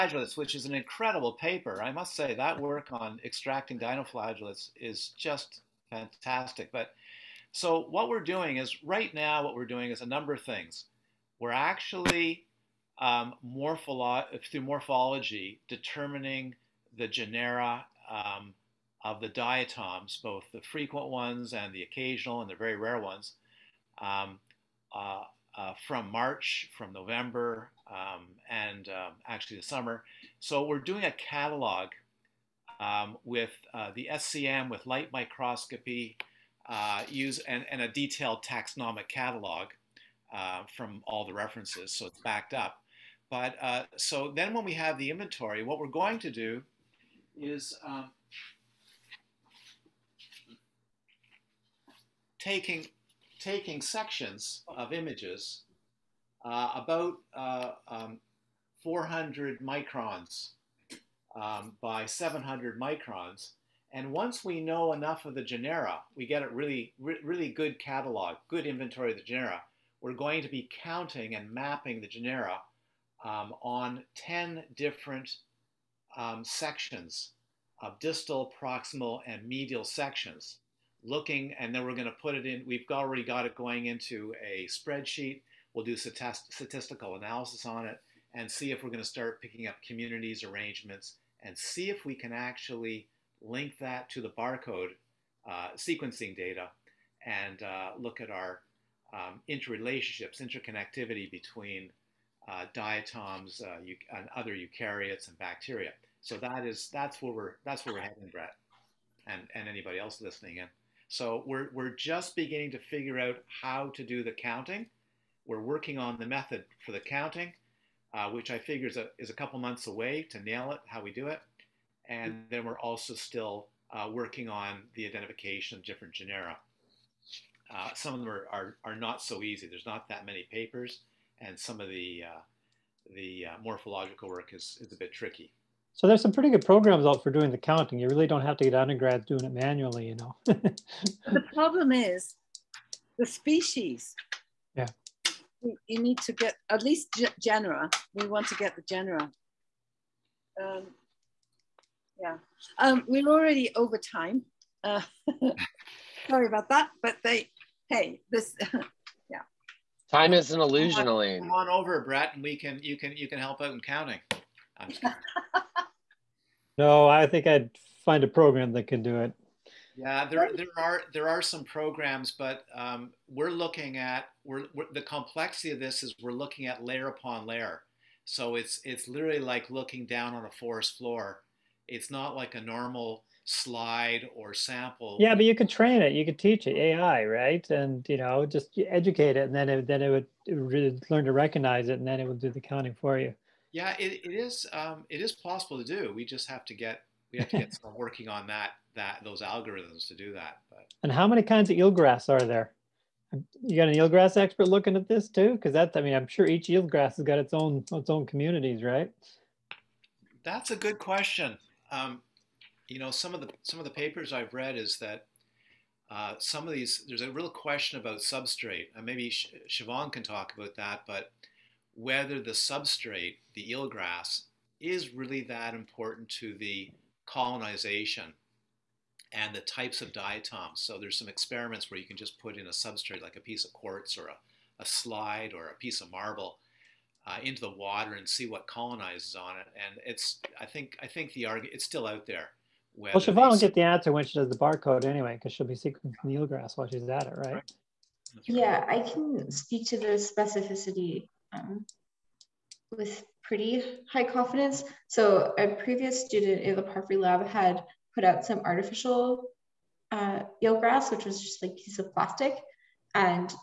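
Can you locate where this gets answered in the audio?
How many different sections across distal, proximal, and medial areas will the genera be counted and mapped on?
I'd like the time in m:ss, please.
1:14.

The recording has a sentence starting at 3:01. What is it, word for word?
It's not like a normal slide or sample.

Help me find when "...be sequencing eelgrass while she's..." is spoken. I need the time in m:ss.
4:05.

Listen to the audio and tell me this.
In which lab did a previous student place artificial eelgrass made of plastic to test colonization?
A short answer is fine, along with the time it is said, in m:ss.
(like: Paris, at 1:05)
Parfrey lab, at 4:16.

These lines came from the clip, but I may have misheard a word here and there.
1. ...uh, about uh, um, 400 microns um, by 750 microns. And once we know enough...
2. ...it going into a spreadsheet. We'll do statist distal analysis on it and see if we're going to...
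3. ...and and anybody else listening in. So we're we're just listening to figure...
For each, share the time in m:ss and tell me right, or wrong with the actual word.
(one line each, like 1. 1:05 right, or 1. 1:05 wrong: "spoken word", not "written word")
1. 0:56 wrong: "700", not "750"
2. 1:23 wrong: "statistical", not "distal"
3. 1:49 wrong: "beginning", not "listening".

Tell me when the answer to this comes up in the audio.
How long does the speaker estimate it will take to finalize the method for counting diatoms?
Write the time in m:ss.
1:59.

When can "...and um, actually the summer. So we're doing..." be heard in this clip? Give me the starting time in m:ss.
0:28.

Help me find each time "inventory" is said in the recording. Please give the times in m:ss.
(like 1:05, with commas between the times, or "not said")
0:45, 1:08.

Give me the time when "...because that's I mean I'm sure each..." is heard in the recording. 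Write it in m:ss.
3:25.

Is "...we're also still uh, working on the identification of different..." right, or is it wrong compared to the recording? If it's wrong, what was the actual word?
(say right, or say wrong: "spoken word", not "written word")
right.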